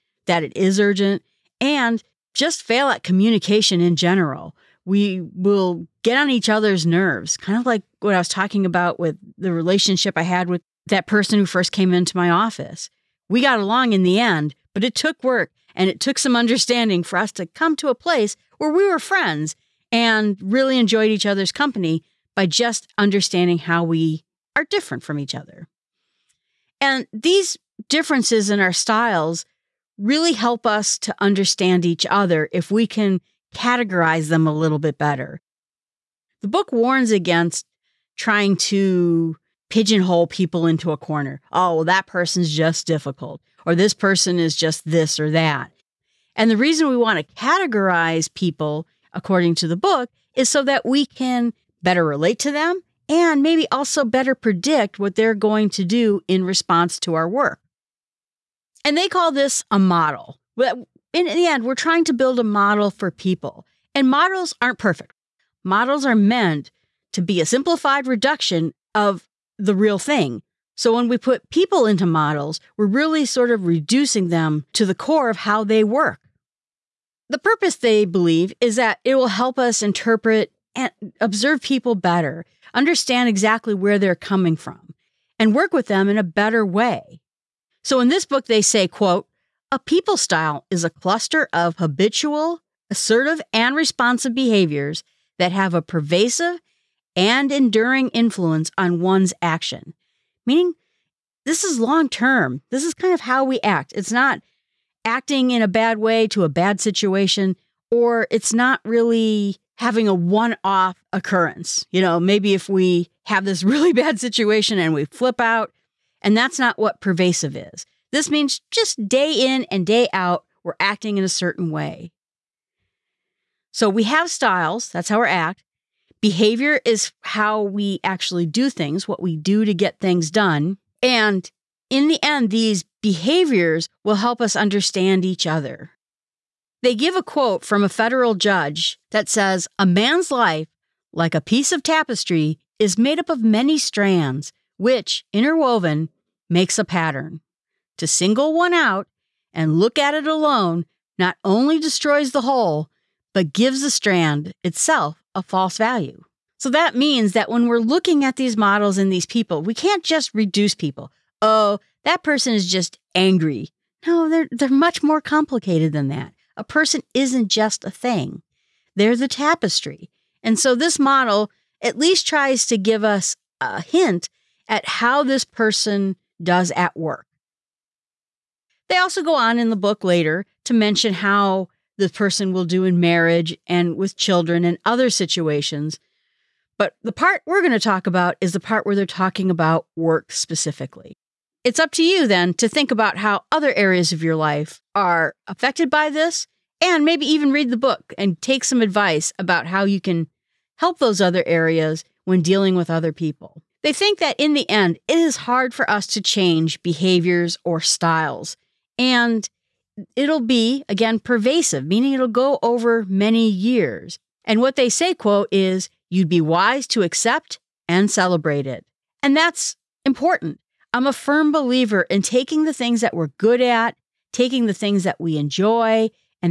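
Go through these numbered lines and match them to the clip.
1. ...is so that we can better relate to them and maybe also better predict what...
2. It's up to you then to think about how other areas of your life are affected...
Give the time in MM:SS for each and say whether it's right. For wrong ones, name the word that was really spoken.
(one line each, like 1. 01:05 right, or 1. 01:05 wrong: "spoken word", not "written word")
1. 00:50 right
2. 03:11 right.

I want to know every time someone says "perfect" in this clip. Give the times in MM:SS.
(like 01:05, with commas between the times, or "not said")
01:04.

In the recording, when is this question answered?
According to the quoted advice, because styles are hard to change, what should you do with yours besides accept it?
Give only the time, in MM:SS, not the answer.
03:38.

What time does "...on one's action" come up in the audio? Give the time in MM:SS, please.
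01:38.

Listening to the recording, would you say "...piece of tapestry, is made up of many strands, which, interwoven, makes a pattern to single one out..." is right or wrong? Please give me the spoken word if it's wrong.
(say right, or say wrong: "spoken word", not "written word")
right.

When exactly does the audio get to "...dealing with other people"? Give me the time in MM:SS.
03:22.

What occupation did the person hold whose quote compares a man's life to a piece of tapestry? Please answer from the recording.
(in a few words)
federal judge.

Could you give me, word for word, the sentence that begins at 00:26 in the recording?
And these differences in our styles really help us to understand each other if we can categorize them a little bit better.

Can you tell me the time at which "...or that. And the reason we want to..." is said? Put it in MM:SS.
00:45.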